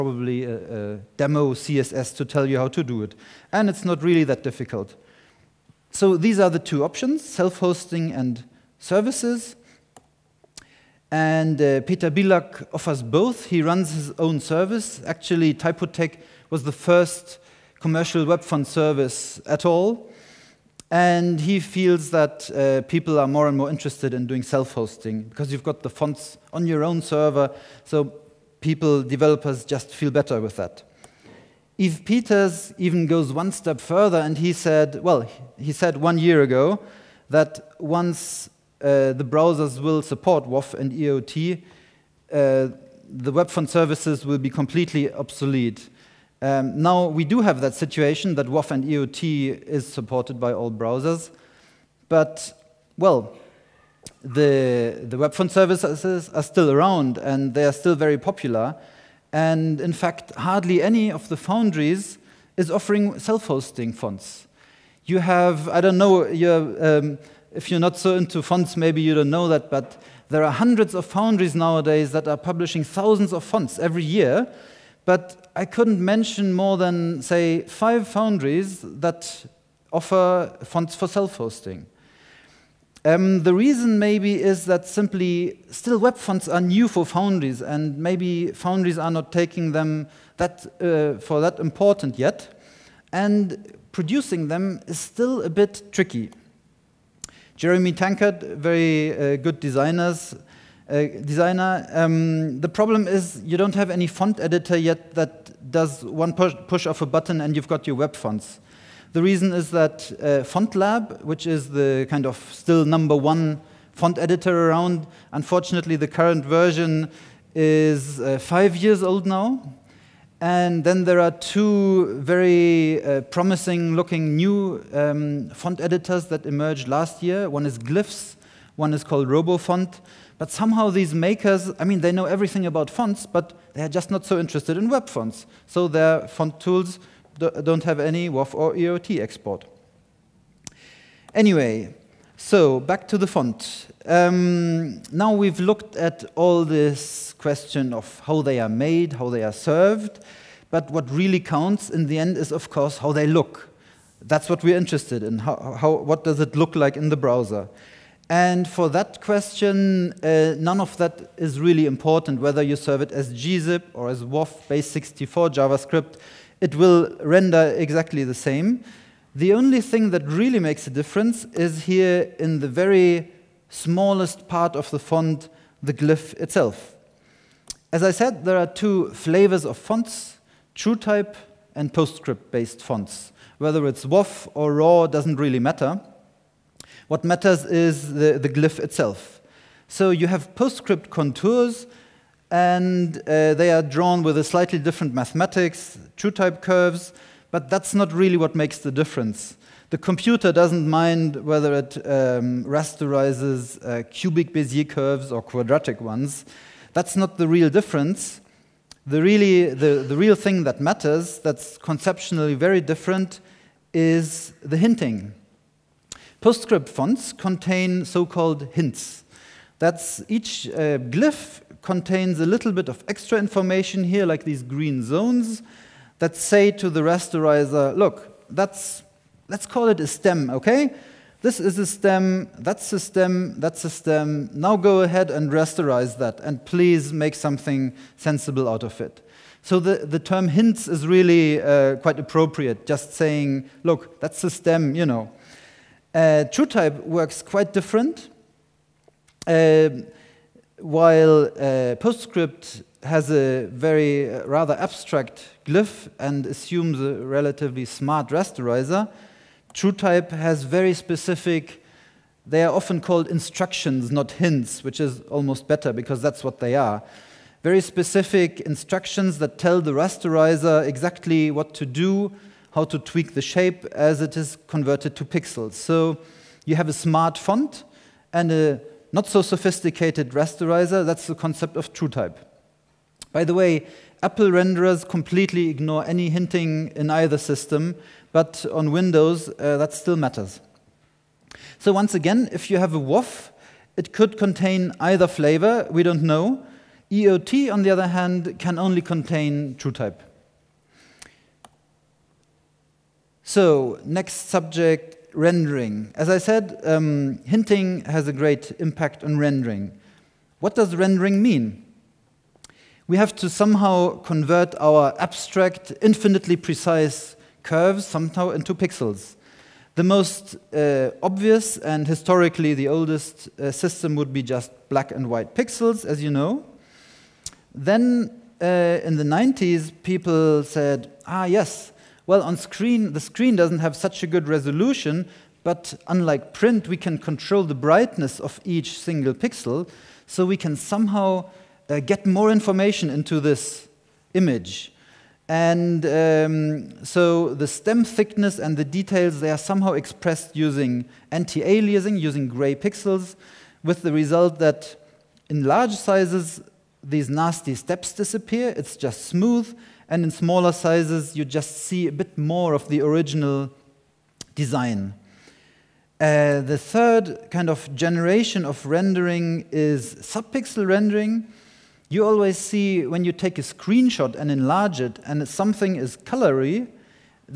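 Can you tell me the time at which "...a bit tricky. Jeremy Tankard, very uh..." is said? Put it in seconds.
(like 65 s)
95 s.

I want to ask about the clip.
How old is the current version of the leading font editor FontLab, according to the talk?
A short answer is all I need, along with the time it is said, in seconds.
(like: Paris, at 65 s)
5 years, at 118 s.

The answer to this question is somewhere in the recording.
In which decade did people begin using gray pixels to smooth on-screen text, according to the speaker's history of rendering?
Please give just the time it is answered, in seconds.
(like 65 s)
329 s.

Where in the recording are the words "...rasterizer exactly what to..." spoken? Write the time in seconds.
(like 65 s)
269 s.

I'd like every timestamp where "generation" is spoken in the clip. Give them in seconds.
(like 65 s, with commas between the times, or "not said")
367 s.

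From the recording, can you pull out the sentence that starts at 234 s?
Now go ahead and rasterize that, and please make something sensible out of it.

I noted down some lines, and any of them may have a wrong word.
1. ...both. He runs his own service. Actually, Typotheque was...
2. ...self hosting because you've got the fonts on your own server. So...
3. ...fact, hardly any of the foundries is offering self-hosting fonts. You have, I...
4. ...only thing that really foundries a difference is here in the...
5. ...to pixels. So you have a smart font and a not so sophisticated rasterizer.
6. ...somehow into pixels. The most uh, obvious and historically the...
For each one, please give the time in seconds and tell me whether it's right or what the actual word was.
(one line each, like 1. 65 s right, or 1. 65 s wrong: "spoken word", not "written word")
1. 13 s right
2. 24 s right
3. 59 s right
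4. 169 s wrong: "makes", not "foundries"
5. 275 s right
6. 318 s right.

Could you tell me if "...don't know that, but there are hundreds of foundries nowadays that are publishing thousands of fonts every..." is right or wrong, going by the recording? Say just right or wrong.
right.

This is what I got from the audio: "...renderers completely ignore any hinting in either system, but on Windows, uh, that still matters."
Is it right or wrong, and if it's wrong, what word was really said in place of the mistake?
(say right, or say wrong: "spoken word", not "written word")
right.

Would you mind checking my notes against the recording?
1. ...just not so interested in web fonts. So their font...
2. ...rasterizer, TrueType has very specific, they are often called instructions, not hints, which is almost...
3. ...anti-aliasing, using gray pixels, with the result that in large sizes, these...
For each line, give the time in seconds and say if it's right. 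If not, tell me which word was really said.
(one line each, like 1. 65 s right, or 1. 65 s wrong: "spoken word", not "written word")
1. 133 s right
2. 258 s right
3. 351 s right.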